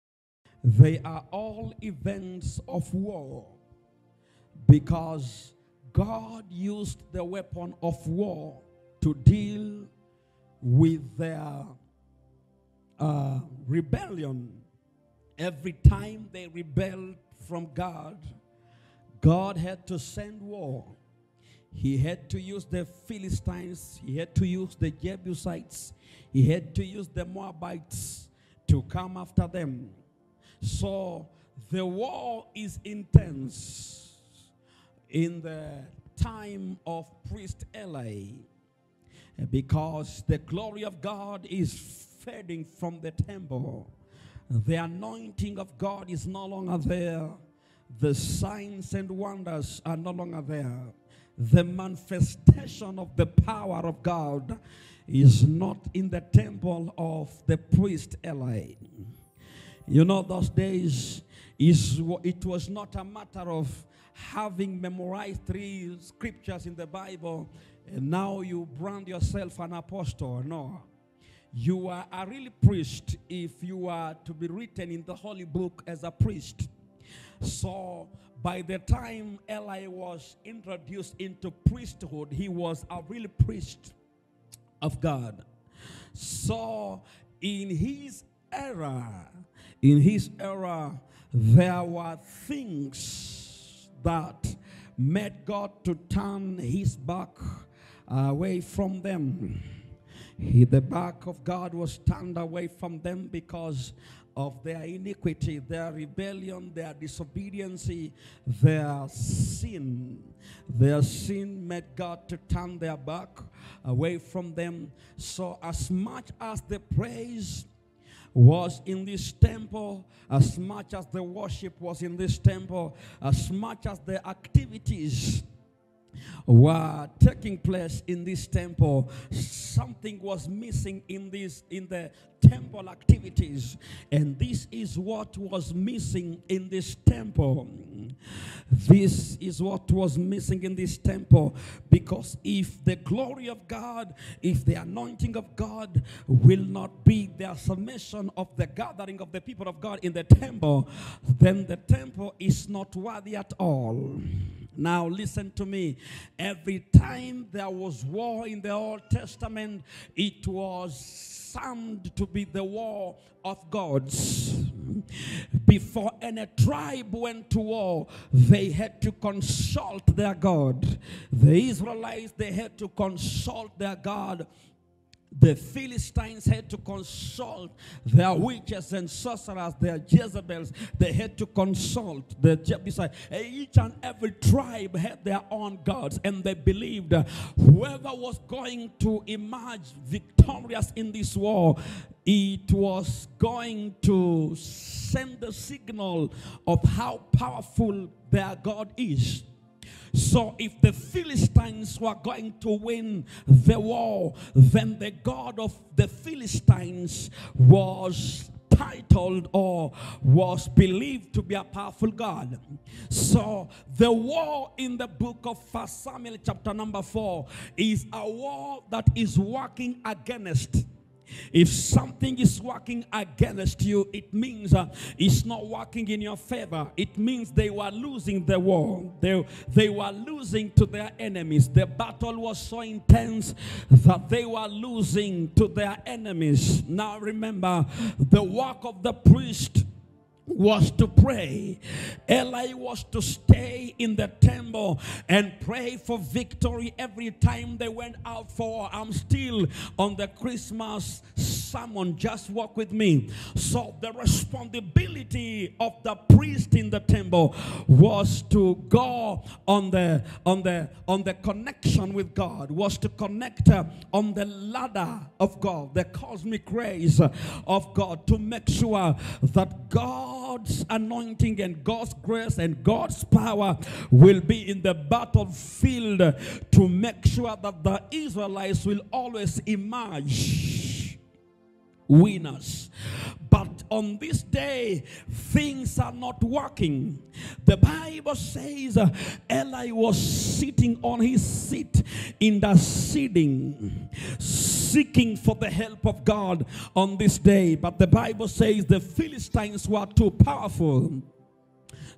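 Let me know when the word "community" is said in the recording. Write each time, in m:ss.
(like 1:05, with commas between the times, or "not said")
not said.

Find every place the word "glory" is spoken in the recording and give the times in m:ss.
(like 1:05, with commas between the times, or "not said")
0:40, 2:22.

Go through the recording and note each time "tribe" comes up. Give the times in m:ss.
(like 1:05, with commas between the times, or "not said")
2:46, 3:04.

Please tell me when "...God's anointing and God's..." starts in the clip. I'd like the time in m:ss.
4:29.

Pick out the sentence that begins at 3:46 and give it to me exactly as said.
It means they were losing the war.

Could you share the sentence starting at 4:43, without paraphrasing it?
But on this day, things are not working.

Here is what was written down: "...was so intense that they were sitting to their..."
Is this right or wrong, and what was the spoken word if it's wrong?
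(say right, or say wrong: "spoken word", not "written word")
wrong: "losing", not "sitting".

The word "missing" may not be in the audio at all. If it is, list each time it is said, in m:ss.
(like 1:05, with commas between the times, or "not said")
2:10, 2:15, 2:20.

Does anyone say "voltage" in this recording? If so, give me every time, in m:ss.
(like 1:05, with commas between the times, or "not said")
not said.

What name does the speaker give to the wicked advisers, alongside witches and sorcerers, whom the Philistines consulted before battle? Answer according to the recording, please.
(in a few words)
Jezebels.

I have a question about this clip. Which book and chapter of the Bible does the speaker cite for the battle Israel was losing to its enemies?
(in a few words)
First Samuel chapter 4.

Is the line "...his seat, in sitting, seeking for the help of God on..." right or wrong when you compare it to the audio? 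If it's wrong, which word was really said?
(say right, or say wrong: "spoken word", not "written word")
right.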